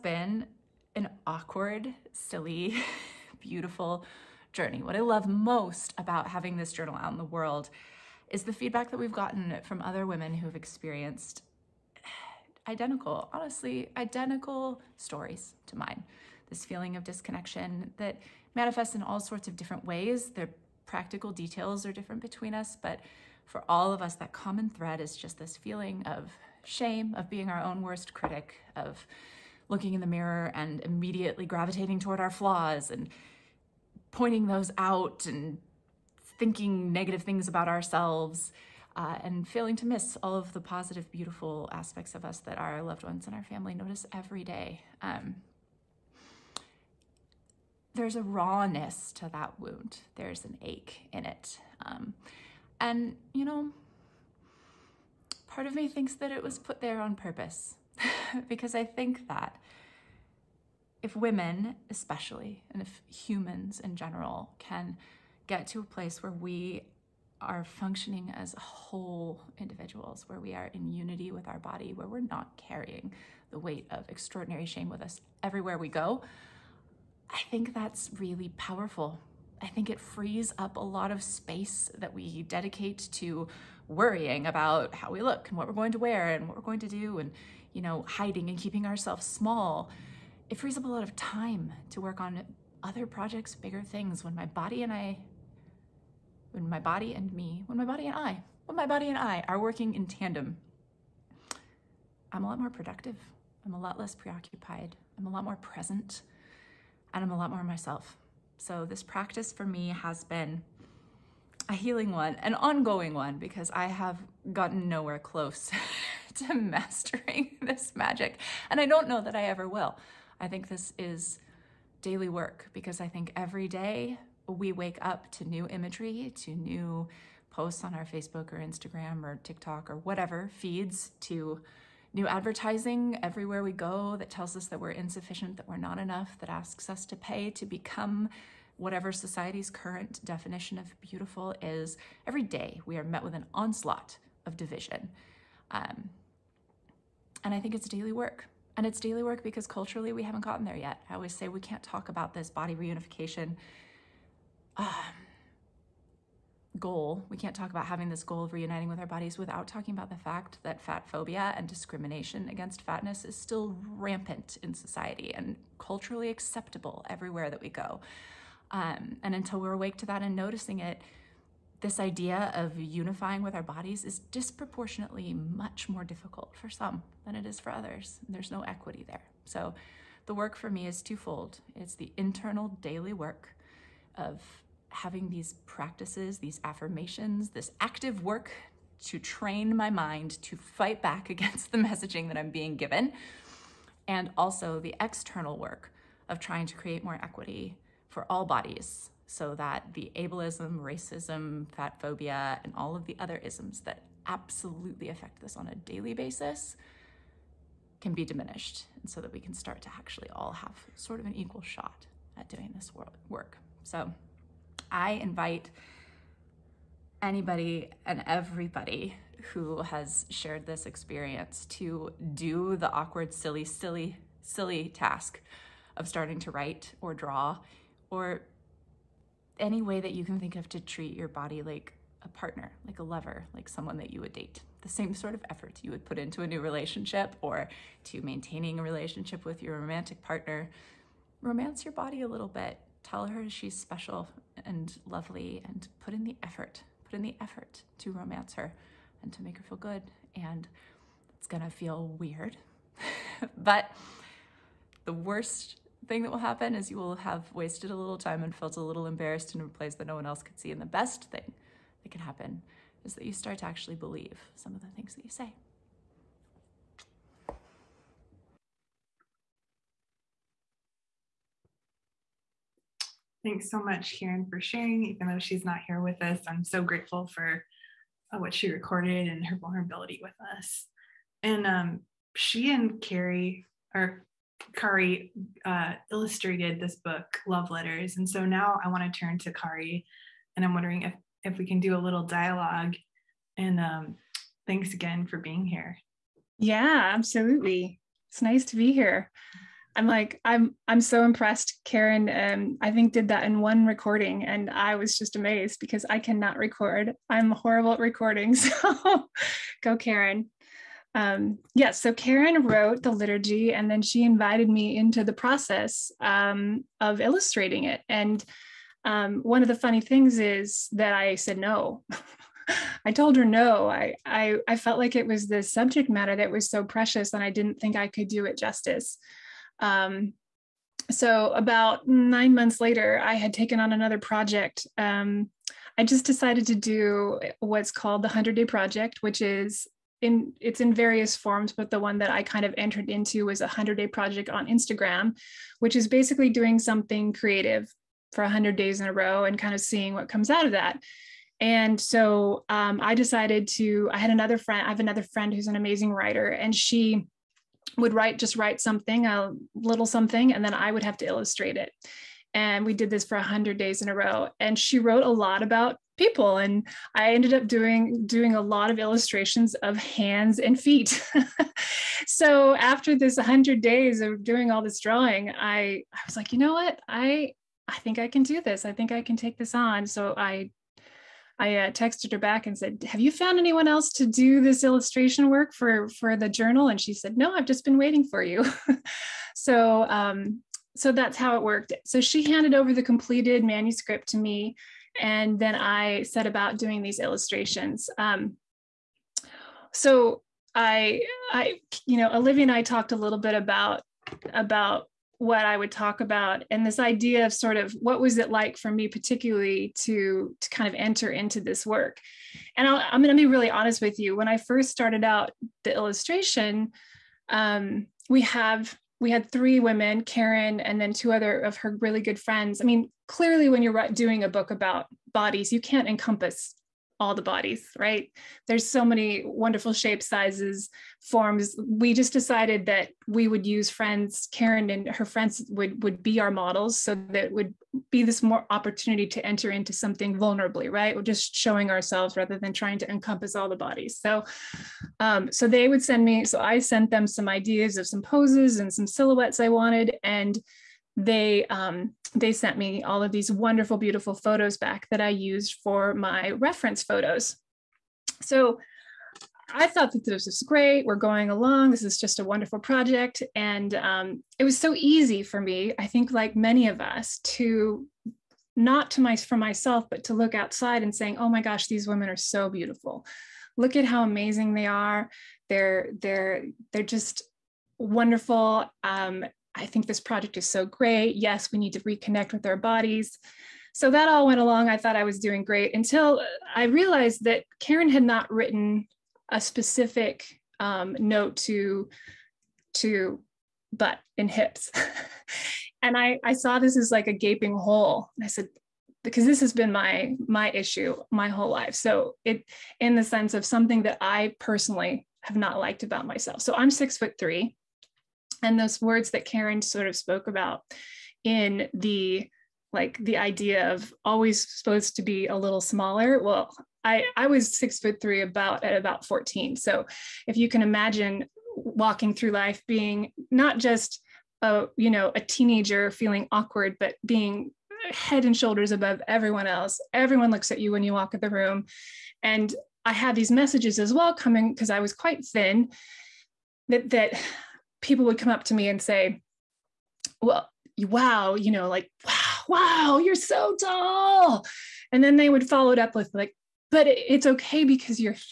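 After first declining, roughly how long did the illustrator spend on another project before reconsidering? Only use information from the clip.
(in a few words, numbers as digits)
9 months.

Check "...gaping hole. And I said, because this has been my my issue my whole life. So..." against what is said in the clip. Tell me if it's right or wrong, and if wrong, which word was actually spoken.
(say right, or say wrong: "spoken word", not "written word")
right.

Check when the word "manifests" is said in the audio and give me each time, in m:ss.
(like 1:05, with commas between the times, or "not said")
0:18.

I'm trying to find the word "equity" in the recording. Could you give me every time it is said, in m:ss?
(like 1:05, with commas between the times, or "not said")
2:58, 3:17.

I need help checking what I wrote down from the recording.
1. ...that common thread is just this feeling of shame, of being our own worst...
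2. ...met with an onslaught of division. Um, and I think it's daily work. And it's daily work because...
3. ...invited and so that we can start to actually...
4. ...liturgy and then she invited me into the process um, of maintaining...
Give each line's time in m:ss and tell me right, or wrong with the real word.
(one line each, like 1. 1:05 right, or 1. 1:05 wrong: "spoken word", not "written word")
1. 0:24 right
2. 2:23 right
3. 3:28 wrong: "diminished", not "invited"
4. 5:13 wrong: "illustrating", not "maintaining".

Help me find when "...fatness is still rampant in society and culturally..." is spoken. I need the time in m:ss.
2:42.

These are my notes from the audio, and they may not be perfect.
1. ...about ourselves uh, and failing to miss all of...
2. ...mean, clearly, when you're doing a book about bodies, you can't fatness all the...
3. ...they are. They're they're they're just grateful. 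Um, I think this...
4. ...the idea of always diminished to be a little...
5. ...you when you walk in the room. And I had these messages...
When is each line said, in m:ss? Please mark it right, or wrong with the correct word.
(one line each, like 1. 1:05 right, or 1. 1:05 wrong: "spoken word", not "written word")
1. 0:37 right
2. 7:02 wrong: "encompass", not "fatness"
3. 7:54 wrong: "wonderful", not "grateful"
4. 8:33 wrong: "supposed", not "diminished"
5. 8:50 right.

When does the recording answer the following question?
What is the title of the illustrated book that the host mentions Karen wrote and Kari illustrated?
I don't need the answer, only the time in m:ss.
4:47.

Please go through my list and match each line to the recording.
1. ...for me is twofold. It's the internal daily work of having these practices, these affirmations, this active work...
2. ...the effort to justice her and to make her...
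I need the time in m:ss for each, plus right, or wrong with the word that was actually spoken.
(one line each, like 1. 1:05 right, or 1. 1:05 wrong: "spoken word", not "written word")
1. 3:00 right
2. 4:07 wrong: "romance", not "justice".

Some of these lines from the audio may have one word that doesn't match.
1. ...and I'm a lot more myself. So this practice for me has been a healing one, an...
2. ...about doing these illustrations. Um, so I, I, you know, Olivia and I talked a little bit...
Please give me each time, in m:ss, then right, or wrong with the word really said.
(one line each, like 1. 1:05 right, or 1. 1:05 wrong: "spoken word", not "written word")
1. 1:47 right
2. 6:36 right.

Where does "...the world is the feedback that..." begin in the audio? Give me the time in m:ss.
0:07.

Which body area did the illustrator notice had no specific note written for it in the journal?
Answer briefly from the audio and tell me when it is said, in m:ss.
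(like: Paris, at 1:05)
butt and hips, at 8:13.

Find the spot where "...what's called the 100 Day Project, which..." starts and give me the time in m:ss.
5:37.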